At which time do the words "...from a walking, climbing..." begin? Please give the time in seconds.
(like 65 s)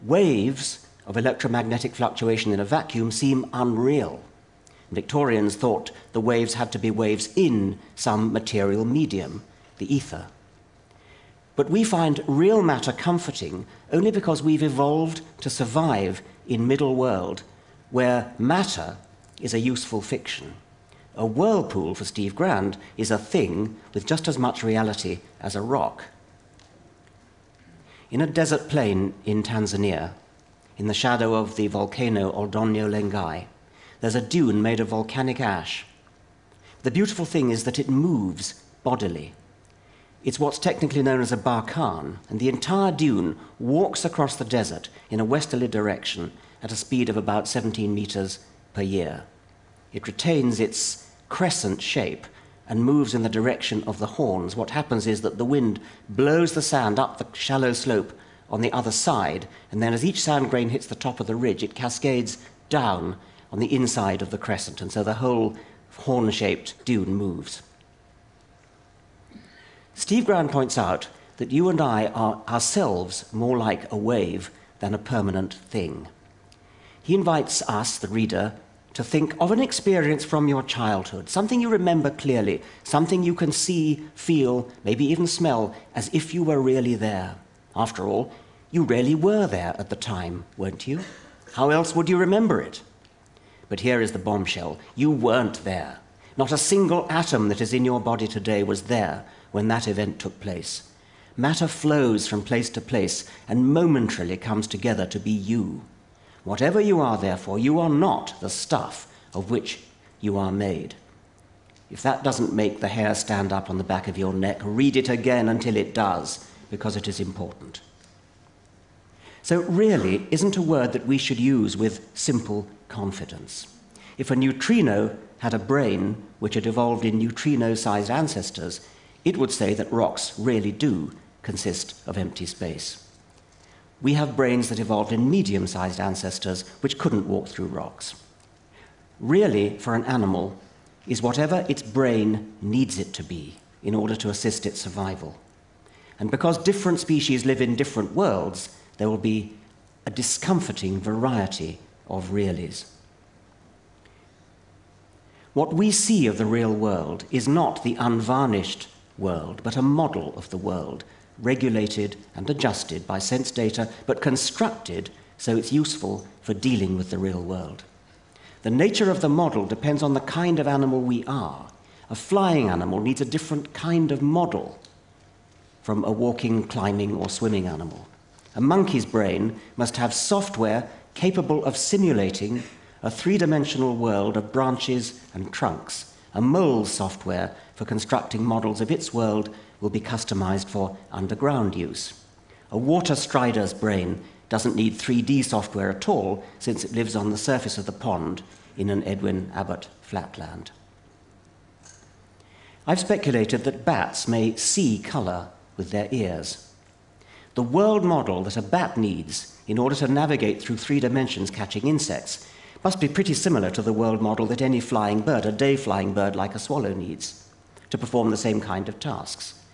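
175 s.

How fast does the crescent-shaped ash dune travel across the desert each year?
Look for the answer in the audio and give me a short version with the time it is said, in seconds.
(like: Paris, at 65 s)
17 meters per year, at 47 s.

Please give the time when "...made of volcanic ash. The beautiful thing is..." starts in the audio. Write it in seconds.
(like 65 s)
34 s.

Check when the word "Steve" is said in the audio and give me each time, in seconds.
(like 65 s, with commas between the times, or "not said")
22 s, 69 s.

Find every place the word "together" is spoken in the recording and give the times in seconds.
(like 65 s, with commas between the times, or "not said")
104 s.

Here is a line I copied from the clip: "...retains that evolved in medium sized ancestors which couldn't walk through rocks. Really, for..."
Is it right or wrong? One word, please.
wrong.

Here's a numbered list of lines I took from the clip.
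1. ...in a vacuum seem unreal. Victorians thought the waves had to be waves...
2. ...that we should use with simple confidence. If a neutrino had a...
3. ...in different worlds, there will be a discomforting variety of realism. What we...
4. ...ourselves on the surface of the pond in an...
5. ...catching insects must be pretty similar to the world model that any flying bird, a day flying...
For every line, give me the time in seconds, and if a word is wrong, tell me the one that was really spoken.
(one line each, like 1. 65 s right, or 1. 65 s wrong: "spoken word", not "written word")
1. 2 s right
2. 120 s right
3. 147 s right
4. 196 s wrong: "lives", not "ourselves"
5. 211 s right.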